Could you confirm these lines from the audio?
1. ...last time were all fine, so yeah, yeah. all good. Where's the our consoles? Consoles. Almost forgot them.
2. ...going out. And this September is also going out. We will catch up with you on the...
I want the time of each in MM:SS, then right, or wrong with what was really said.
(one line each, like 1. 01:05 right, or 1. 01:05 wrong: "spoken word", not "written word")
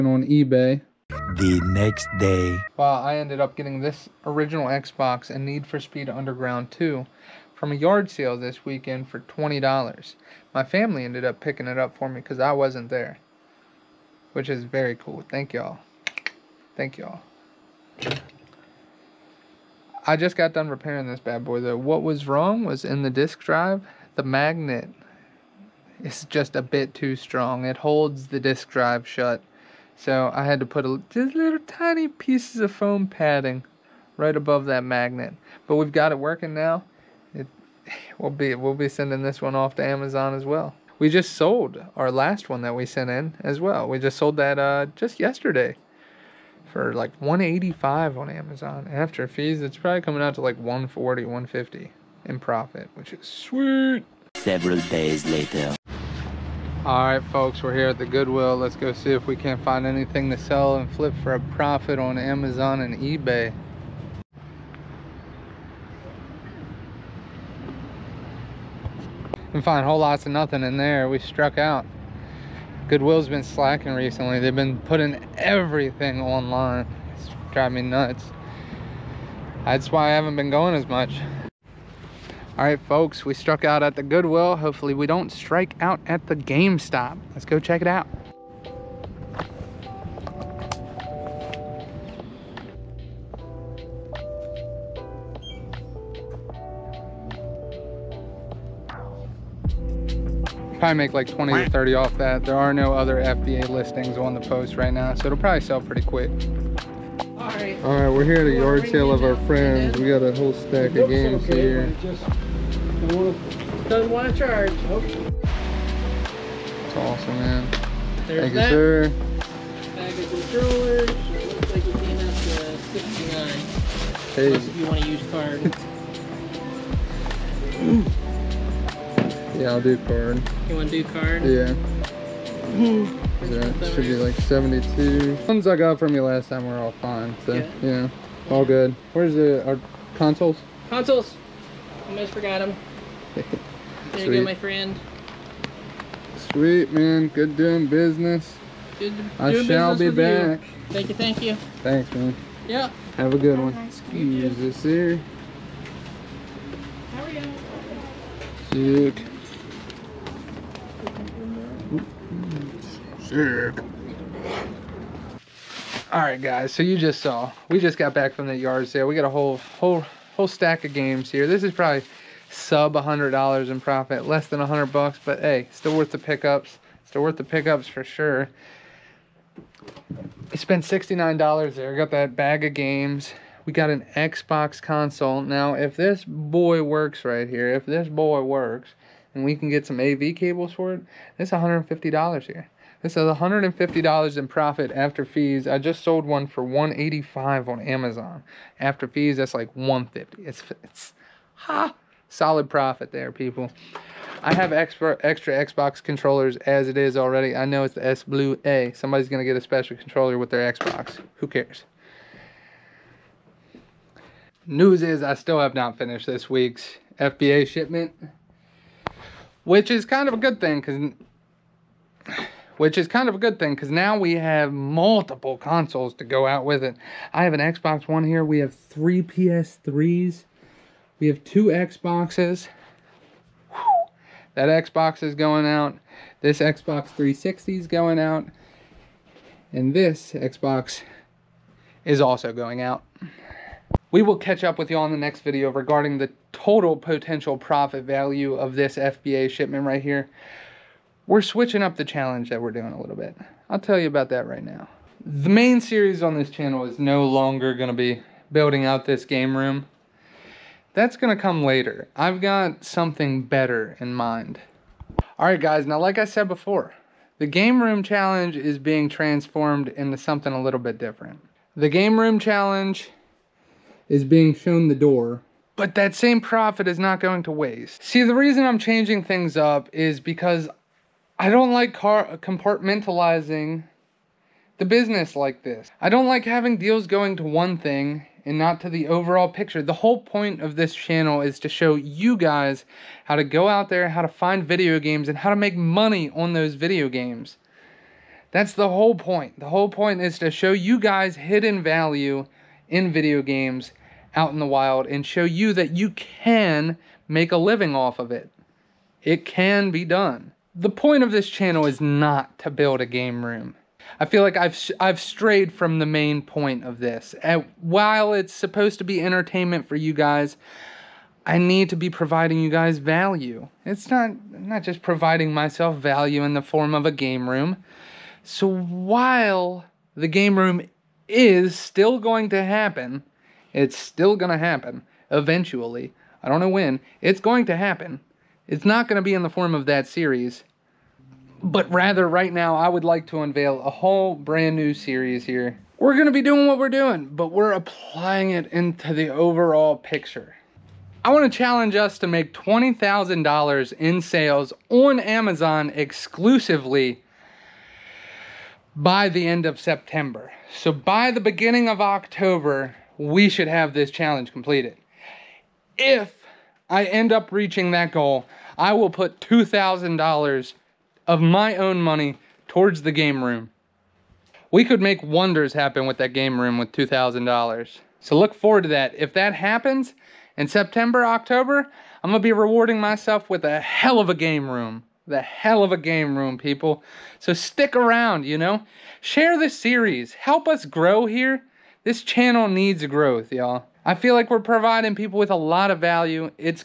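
1. 02:16 right
2. 03:57 wrong: "Xbox", not "September".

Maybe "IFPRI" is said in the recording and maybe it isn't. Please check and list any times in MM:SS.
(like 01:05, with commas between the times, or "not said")
not said.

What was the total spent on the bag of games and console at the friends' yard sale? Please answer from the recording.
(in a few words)
$69.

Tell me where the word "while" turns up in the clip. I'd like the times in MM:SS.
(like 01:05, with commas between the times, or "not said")
05:17, 05:28.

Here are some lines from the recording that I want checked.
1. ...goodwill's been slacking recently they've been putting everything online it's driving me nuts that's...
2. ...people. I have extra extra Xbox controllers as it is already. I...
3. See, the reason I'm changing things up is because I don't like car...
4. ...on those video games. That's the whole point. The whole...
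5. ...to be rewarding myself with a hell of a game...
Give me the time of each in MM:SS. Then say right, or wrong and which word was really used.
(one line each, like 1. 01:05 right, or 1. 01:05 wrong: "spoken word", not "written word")
1. 01:12 right
2. 03:23 right
3. 04:38 right
4. 04:56 right
5. 06:22 right.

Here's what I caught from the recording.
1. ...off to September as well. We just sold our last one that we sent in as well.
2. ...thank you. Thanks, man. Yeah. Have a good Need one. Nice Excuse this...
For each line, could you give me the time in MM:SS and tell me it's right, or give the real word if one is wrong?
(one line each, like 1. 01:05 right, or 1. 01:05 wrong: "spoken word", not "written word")
1. 00:39 wrong: "Amazon", not "September"
2. 02:31 wrong: "Have", not "Need".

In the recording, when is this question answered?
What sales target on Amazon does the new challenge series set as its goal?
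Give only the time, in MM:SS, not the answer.
05:52.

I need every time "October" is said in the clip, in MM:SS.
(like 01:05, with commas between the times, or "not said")
06:02, 06:21.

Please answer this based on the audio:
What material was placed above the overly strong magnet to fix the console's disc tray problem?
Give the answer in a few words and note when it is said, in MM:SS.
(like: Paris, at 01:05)
foam padding, at 00:32.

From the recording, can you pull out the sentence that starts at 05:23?
It's not not just providing myself value in the form of a game room.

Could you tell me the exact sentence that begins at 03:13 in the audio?
This is $150 in profit after fees.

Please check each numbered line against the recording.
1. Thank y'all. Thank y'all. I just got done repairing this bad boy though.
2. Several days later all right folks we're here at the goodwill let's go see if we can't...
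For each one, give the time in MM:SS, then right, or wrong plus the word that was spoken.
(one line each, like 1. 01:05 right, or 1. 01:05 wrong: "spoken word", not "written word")
1. 00:15 right
2. 00:54 right.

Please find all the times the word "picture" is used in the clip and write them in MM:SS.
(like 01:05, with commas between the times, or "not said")
04:49, 05:49.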